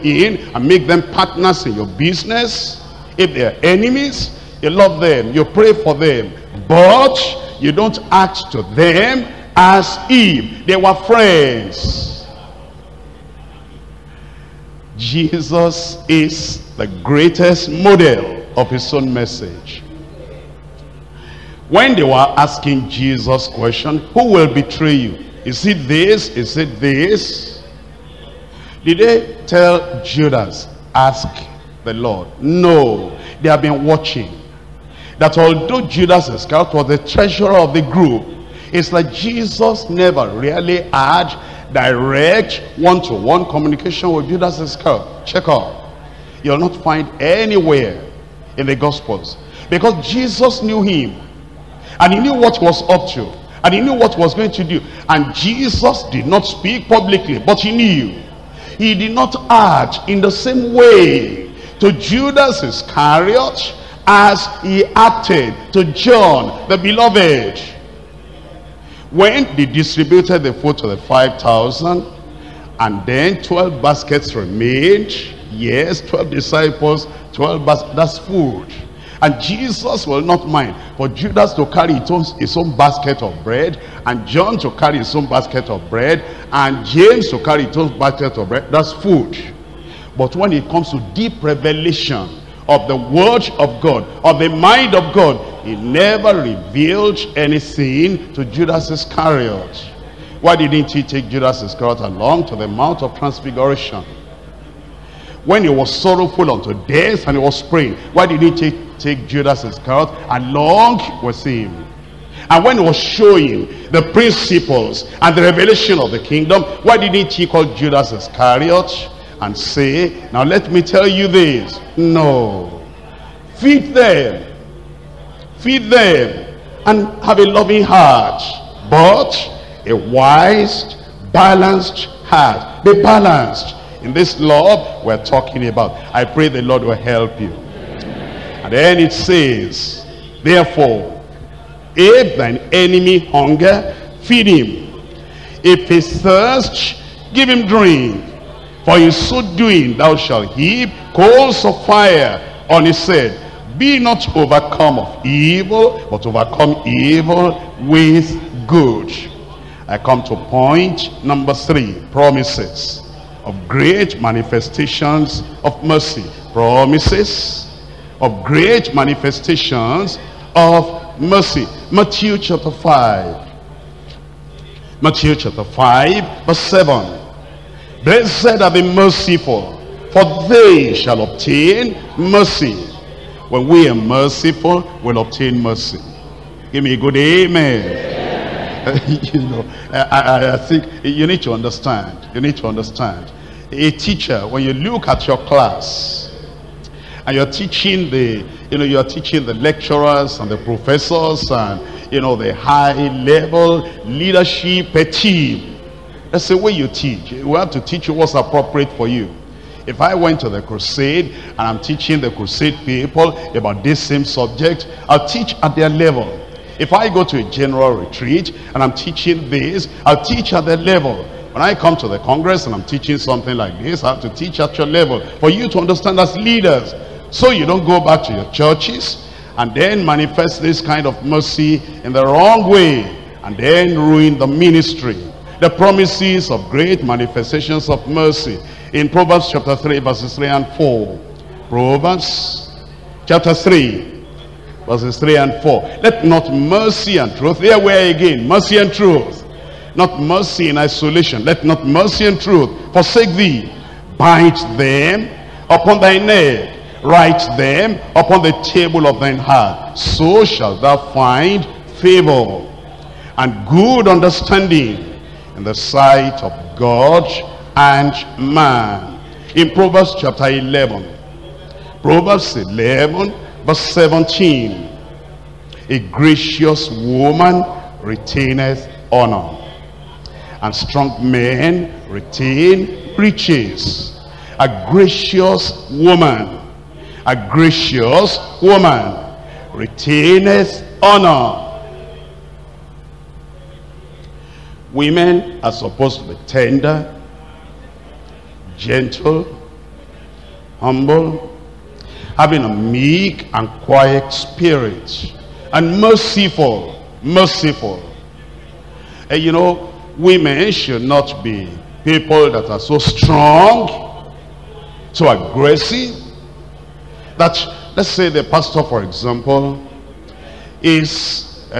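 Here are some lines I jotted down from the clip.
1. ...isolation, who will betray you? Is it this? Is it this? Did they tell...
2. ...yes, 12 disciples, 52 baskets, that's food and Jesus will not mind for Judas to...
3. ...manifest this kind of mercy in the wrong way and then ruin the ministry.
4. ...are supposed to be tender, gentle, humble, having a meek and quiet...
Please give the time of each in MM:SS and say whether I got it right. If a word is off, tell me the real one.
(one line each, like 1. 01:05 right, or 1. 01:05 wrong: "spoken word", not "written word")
1. 00:23 wrong: "question", not "isolation"
2. 01:15 wrong: "12", not "52"
3. 03:50 right
4. 04:55 right.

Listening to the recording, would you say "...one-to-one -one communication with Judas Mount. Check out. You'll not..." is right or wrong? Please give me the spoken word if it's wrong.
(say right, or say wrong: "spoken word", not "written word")
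wrong: "Iscariot", not "Mount".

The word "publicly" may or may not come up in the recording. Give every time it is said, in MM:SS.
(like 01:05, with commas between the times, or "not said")
00:56.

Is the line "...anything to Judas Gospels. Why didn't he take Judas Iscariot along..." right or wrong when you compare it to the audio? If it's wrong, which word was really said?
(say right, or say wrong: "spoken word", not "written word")
wrong: "Iscariot", not "Gospels".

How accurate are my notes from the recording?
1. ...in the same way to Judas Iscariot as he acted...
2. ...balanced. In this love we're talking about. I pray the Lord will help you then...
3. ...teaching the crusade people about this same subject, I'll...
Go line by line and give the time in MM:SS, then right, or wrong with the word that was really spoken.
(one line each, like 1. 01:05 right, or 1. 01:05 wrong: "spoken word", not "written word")
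1. 01:00 right
2. 02:13 right
3. 03:31 right.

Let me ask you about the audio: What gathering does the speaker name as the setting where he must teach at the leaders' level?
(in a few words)
the Congress.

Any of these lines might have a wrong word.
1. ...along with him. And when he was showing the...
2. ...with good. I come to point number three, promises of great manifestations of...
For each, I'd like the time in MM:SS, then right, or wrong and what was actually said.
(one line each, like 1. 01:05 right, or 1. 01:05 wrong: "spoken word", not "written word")
1. 01:50 right
2. 02:37 right.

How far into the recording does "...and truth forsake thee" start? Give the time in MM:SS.
04:12.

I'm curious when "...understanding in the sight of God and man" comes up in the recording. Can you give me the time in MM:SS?
04:24.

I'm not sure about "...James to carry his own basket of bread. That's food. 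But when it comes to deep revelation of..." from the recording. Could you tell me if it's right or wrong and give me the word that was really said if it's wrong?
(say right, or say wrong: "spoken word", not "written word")
right.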